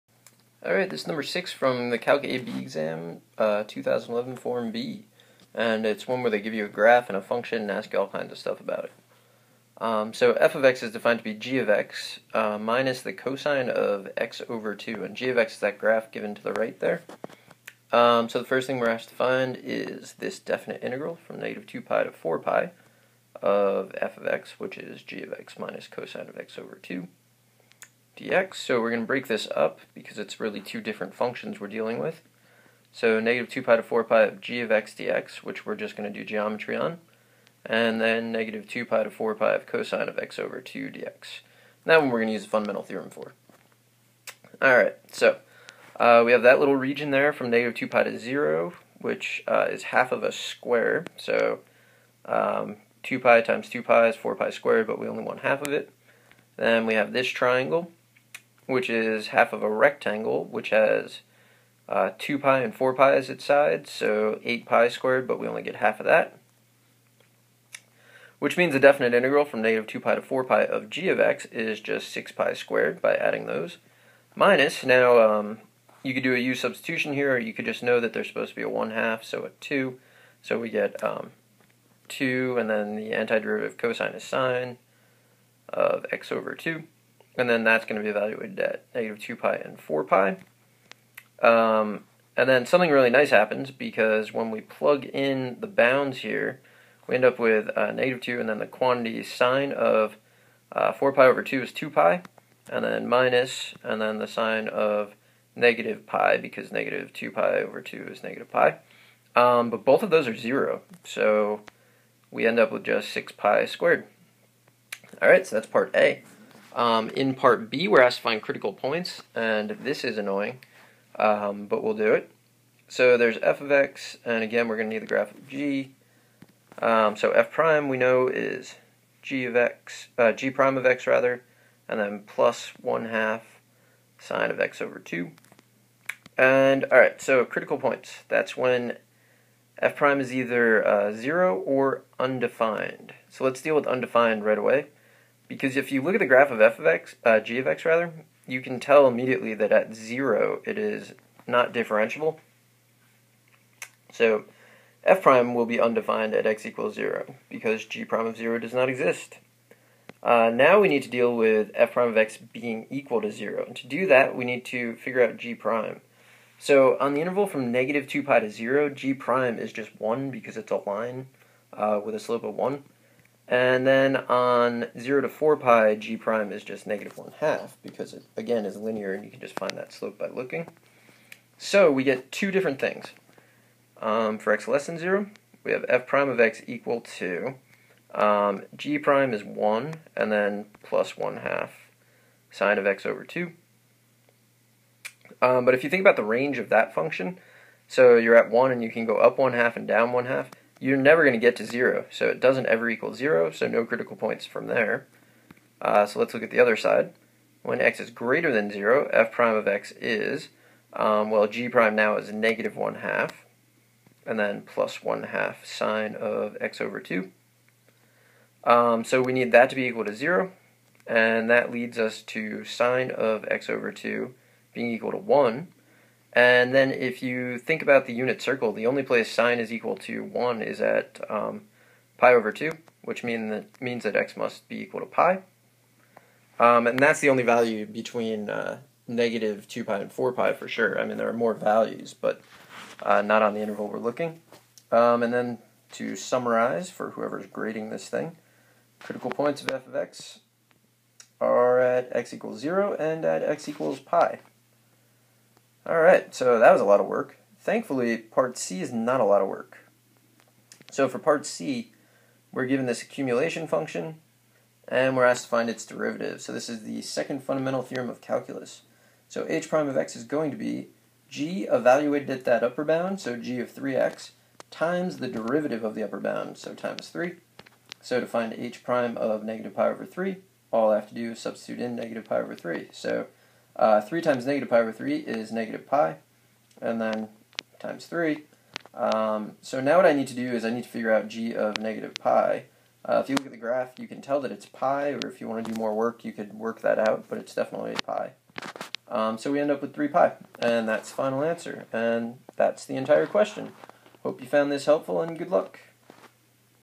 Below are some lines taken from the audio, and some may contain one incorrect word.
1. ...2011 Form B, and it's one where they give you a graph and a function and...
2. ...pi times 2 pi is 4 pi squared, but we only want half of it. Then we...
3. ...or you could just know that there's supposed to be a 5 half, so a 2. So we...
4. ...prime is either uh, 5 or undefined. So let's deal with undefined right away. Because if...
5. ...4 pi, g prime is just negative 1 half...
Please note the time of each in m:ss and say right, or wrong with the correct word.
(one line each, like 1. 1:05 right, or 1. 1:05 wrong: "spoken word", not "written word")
1. 0:03 right
2. 0:53 right
3. 1:17 wrong: "1", not "5"
4. 2:19 wrong: "0", not "5"
5. 2:55 right.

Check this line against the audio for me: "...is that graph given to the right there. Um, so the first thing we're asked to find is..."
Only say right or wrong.
right.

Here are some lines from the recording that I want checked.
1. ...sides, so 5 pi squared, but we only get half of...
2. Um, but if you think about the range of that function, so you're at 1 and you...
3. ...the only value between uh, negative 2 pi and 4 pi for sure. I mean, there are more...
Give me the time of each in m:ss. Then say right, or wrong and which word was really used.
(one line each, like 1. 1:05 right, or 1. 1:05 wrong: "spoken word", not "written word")
1. 1:03 wrong: "8", not "5"
2. 3:15 right
3. 3:57 right.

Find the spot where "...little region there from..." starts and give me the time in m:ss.
0:46.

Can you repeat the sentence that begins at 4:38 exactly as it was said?
So to find h prime of negative pi over 3, all I have to do is substitute in negative pi over 3.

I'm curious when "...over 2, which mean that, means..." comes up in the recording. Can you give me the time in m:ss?
3:52.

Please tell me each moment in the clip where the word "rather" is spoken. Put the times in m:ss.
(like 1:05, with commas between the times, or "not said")
2:11, 2:27.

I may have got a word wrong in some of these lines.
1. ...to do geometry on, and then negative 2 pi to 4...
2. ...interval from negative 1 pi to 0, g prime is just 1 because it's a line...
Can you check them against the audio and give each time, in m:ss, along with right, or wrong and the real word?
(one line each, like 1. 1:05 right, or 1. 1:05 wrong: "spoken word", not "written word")
1. 0:36 right
2. 2:47 wrong: "2", not "1".